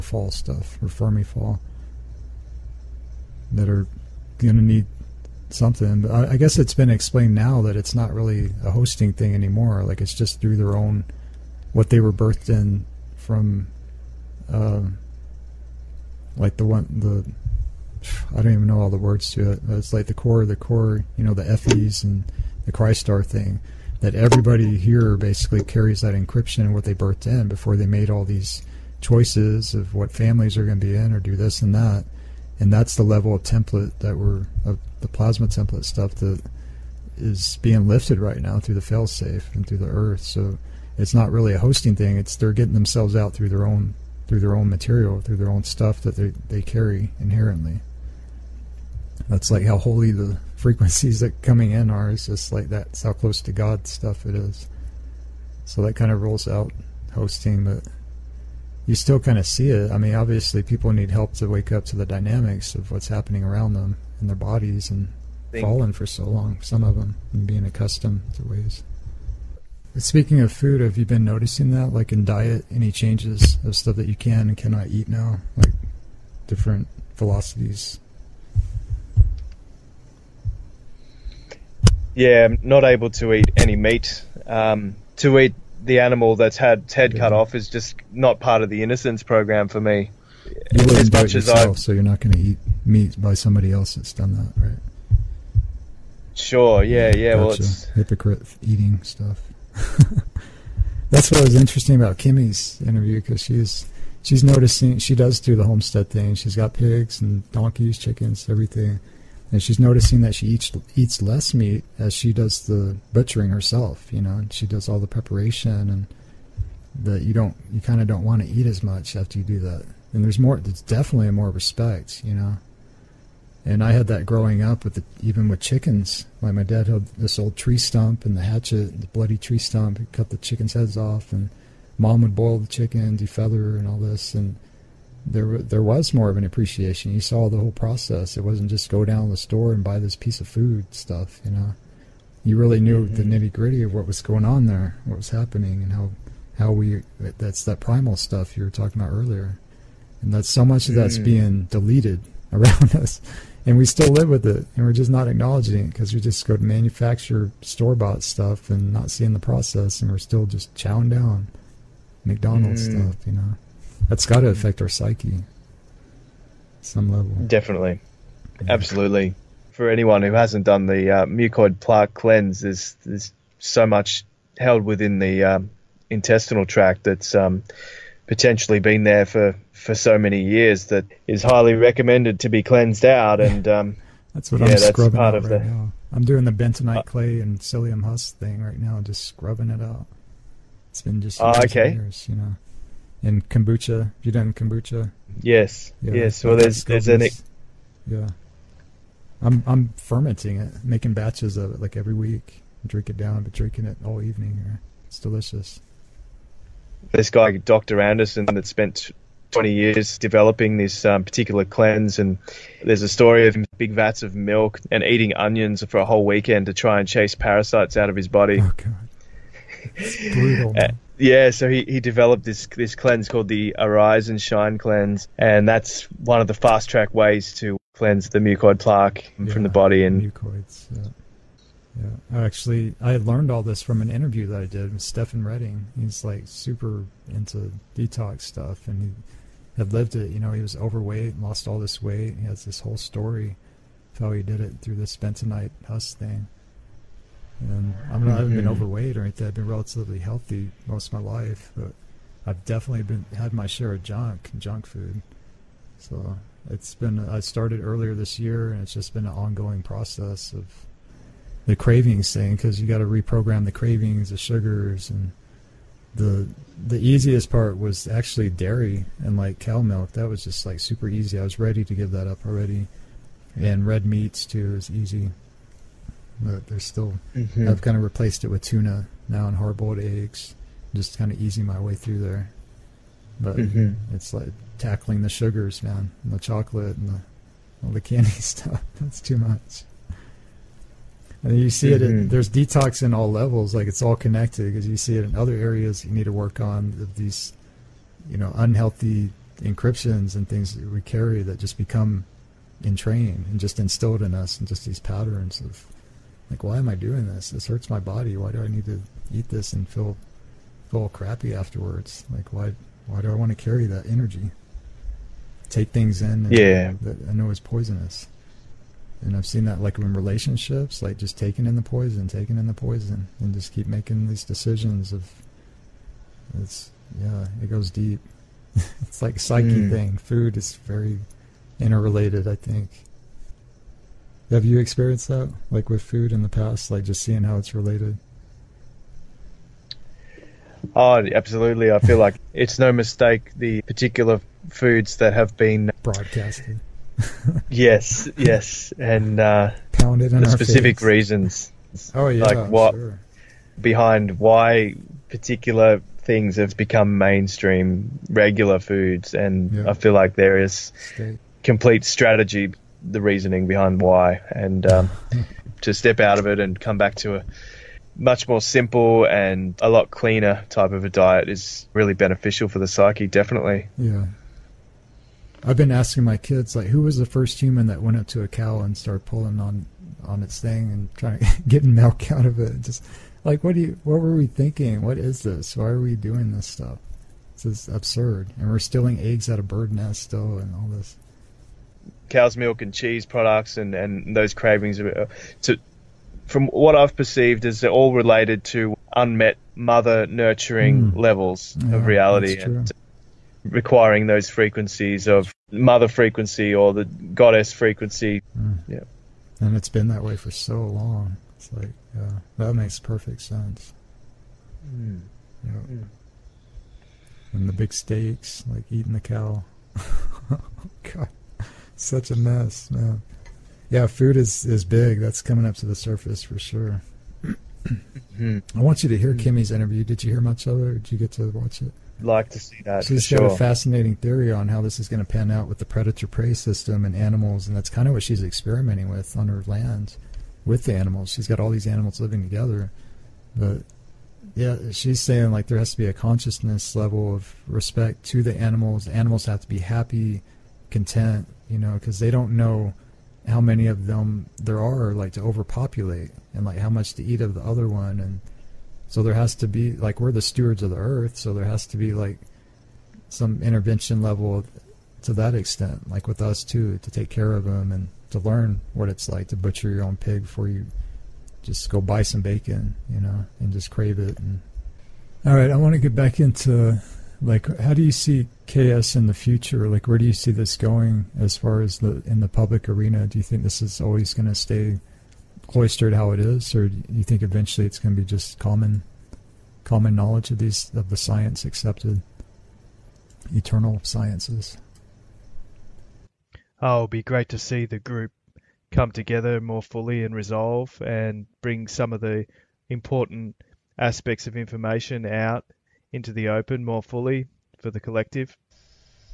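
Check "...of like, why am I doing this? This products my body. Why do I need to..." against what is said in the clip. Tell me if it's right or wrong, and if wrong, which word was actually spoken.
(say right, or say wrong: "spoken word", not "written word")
wrong: "hurts", not "products".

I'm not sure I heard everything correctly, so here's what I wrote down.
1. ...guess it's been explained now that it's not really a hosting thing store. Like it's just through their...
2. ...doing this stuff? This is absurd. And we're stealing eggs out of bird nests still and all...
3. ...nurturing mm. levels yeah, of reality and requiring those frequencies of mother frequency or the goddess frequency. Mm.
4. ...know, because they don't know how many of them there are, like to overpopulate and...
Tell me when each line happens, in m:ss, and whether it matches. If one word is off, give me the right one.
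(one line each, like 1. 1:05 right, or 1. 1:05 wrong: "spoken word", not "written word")
1. 0:06 wrong: "anymore", not "store"
2. 6:26 right
3. 6:40 right
4. 7:31 right.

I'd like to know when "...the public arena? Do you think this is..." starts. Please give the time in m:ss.
8:02.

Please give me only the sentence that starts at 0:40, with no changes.
So it's not really a hosting thing.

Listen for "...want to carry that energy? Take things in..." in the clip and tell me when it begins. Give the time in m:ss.
5:13.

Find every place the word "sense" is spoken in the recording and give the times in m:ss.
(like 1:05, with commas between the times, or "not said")
6:53.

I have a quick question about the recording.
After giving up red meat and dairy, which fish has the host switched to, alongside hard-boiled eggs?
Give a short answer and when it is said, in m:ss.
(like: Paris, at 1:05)
tuna, at 4:38.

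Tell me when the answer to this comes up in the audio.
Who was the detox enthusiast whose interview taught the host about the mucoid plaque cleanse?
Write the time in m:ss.
3:55.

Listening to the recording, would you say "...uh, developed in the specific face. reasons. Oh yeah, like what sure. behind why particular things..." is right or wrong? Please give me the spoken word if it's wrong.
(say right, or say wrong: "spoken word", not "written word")
wrong: "pounded", not "developed".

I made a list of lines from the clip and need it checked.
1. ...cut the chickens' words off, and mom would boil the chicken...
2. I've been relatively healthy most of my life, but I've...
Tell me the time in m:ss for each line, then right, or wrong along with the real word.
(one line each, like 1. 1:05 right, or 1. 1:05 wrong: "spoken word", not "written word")
1. 2:10 wrong: "heads", not "words"
2. 4:09 right.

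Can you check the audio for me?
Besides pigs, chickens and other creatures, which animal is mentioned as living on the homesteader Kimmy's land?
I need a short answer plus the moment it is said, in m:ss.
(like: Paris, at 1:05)
donkeys, at 1:47.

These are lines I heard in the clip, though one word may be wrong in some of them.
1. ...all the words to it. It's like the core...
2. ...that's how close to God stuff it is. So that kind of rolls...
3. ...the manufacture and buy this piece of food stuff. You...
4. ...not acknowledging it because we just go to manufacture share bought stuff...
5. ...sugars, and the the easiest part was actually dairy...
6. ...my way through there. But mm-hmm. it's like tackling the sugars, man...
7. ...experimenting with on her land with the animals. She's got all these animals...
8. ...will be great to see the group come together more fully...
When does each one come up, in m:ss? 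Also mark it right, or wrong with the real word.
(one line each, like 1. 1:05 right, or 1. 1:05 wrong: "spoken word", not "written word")
1. 0:18 right
2. 0:52 right
3. 2:19 wrong: "store", not "manufacture"
4. 2:35 wrong: "store", not "share"
5. 4:24 right
6. 4:41 right
7. 7:18 right
8. 8:16 right.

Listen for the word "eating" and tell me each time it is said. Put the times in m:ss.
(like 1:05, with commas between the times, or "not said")
1:38, 3:35, 6:58.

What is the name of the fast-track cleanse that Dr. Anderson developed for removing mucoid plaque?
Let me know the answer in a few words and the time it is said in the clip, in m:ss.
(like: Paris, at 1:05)
Arise and Shine, at 3:43.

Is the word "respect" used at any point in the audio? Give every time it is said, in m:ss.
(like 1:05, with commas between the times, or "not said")
2:01, 7:27.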